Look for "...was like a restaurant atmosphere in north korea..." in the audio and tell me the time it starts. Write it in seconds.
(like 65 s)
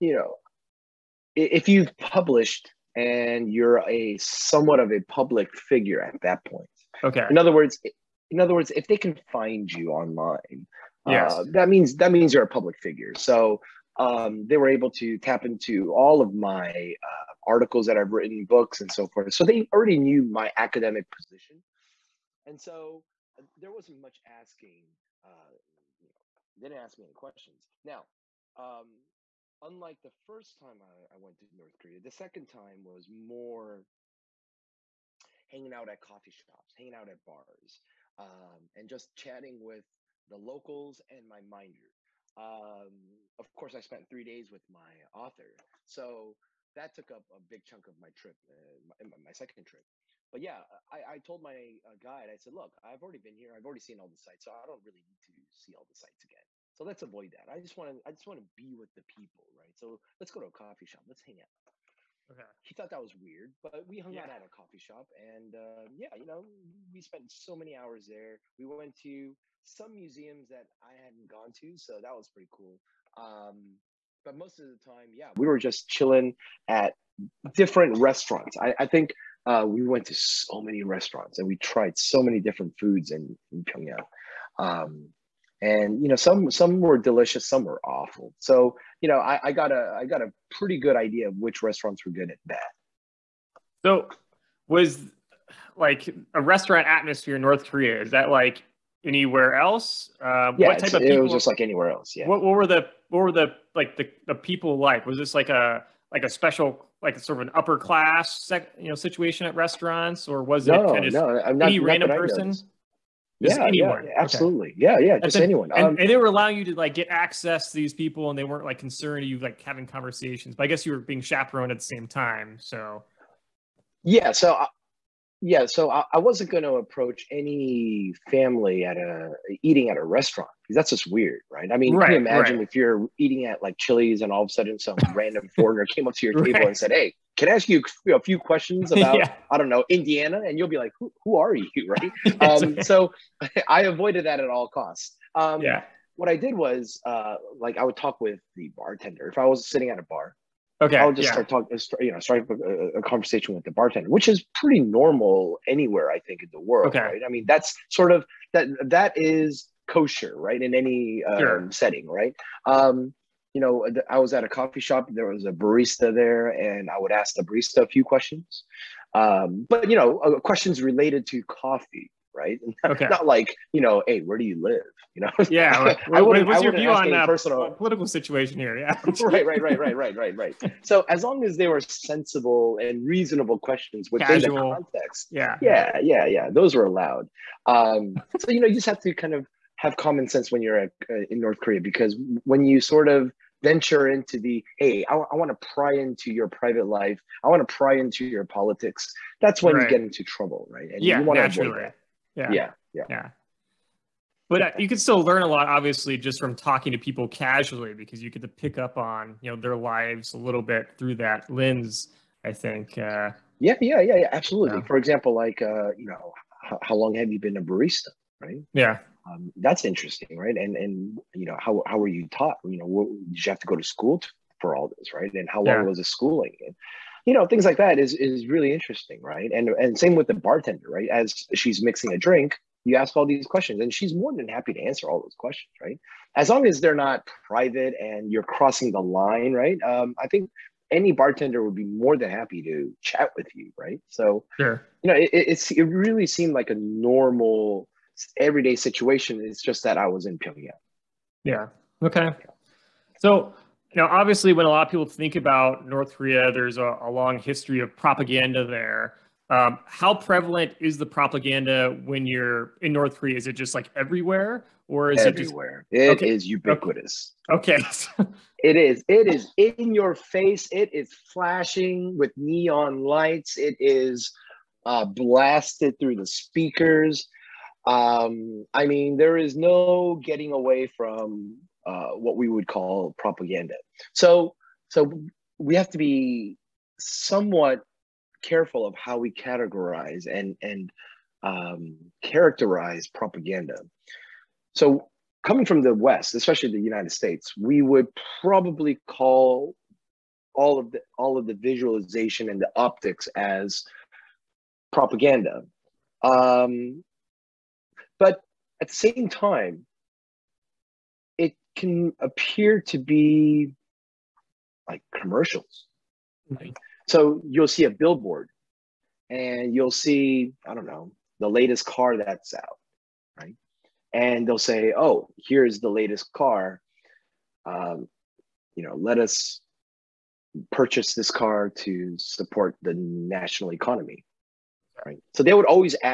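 94 s.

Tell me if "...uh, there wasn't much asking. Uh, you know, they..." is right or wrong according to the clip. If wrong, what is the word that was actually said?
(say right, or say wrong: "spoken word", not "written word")
right.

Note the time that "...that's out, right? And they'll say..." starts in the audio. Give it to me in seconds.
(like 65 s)
322 s.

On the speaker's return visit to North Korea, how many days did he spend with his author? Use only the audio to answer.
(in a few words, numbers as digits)
3 days.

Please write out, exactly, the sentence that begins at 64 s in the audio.
out at a coffee shop, and uh, yeah, you know, we spent so many hours there.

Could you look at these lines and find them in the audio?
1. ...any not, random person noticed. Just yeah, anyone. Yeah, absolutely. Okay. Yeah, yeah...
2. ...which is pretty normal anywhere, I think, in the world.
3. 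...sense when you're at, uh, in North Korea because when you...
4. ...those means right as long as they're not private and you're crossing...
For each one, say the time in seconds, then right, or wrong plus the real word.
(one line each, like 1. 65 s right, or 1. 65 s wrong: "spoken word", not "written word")
1. 111 s right
2. 154 s right
3. 190 s right
4. 235 s wrong: "questions", not "means".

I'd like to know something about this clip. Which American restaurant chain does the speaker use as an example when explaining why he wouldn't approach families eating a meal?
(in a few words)
Chili's.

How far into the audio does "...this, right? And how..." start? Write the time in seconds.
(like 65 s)
224 s.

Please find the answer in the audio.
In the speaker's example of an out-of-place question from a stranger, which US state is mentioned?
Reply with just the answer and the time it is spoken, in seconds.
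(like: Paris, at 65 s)
Indiana, at 139 s.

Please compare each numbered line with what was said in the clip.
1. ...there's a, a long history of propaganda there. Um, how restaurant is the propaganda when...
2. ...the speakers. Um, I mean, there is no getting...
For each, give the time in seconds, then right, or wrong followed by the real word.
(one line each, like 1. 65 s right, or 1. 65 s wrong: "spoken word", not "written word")
1. 256 s wrong: "prevalent", not "restaurant"
2. 276 s right.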